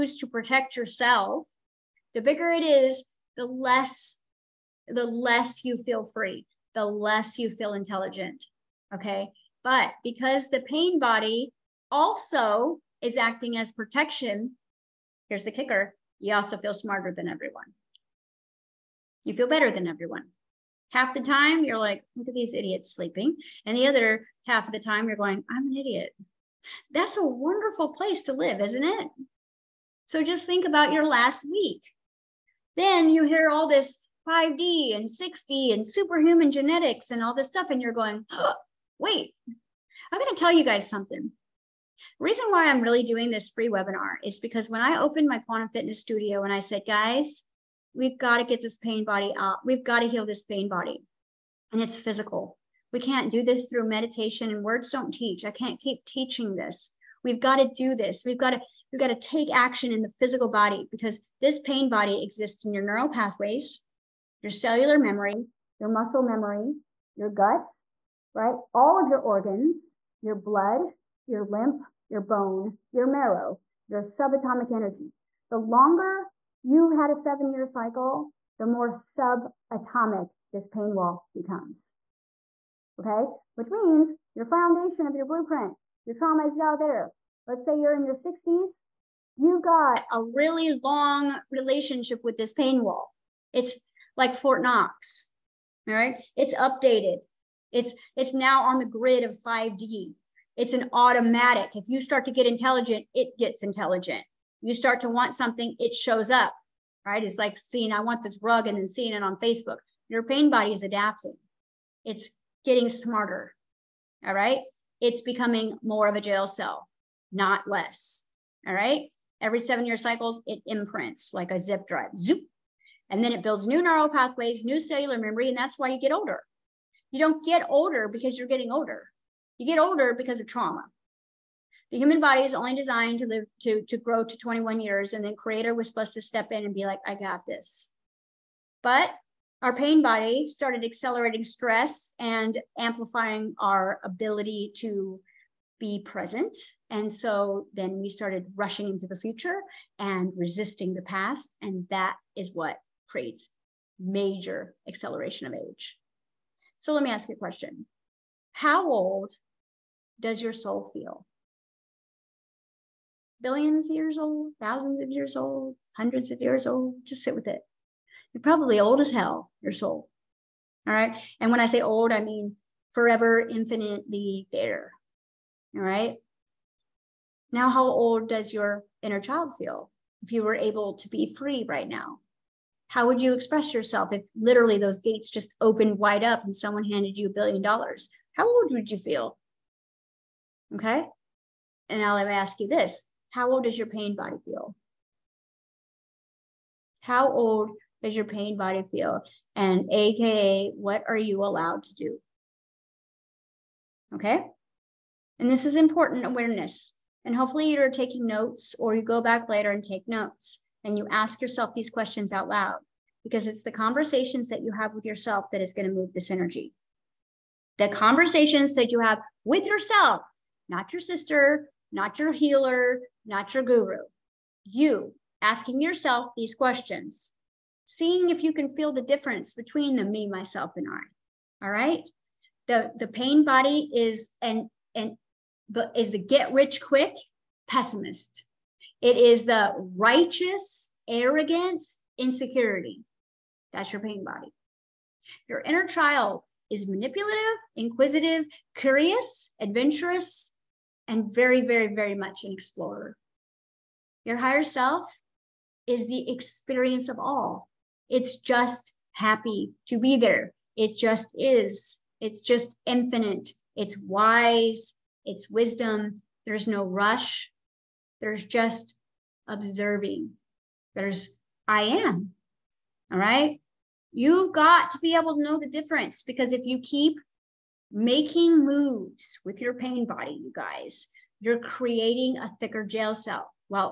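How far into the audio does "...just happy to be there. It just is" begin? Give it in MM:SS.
04:18.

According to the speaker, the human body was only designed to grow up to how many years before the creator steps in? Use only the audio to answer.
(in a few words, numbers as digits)
21.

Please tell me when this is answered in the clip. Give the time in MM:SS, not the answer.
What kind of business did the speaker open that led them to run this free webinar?
00:45.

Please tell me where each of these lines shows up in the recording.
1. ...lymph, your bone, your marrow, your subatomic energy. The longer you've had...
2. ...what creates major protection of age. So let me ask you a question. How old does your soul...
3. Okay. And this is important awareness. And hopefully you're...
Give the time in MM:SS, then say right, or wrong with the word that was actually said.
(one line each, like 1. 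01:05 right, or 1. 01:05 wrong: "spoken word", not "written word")
1. 01:11 right
2. 02:32 wrong: "acceleration", not "protection"
3. 03:24 right.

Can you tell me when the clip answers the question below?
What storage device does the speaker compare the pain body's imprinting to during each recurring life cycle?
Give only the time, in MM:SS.
02:01.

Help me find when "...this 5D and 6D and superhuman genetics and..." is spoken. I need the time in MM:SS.
00:33.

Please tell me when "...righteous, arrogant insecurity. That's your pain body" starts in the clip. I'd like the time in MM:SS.
03:59.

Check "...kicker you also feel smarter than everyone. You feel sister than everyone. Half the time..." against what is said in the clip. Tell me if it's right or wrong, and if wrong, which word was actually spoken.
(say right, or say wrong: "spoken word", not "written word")
wrong: "better", not "sister".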